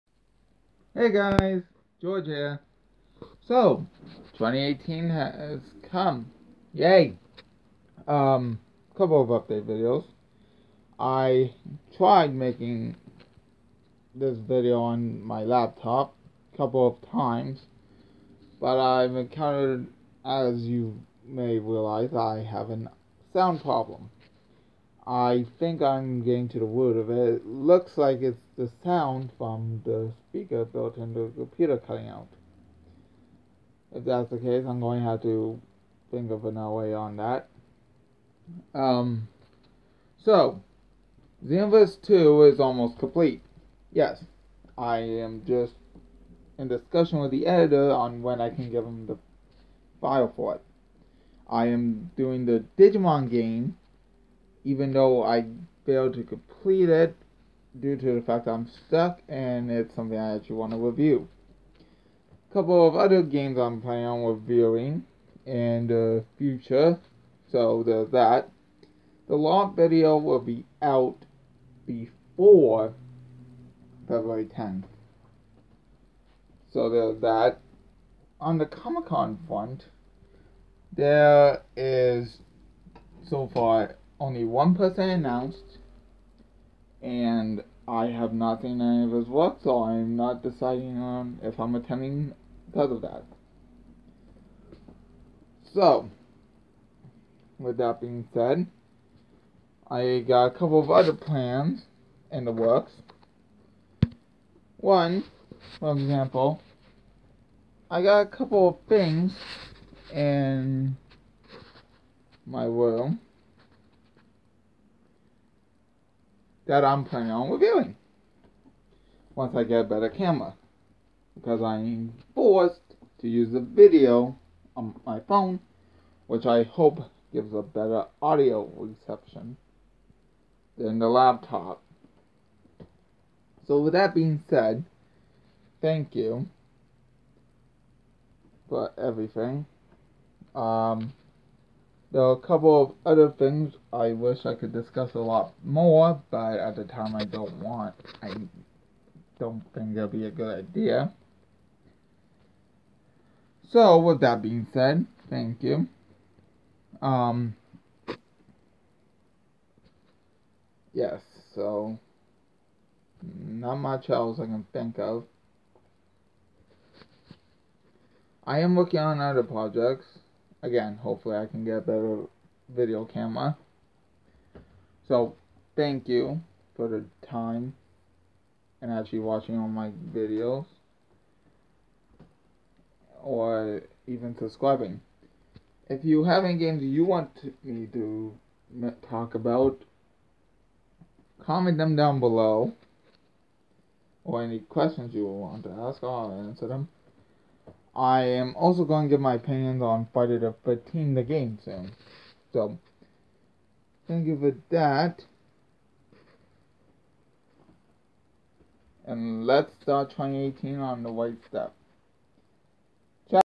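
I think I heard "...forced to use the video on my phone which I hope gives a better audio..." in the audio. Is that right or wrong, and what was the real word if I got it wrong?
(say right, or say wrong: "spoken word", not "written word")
right.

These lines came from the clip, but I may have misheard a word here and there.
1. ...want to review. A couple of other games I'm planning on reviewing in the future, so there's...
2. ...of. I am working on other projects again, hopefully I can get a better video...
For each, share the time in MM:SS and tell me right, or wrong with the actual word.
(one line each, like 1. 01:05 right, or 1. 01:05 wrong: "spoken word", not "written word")
1. 01:00 right
2. 02:44 right.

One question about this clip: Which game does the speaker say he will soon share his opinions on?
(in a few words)
Friday the 13th.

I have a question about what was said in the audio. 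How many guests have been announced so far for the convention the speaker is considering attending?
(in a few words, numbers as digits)
1.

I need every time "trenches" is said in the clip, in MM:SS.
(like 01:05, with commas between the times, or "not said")
not said.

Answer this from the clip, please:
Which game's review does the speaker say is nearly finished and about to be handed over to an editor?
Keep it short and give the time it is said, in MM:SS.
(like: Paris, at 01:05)
Xenoverse 2, at 00:41.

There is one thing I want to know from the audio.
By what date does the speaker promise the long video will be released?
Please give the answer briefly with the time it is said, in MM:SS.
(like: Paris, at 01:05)
February 10th, at 01:14.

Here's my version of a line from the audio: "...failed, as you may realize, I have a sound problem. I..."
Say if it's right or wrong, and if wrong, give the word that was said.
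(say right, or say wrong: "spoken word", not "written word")
wrong: "encountered", not "failed".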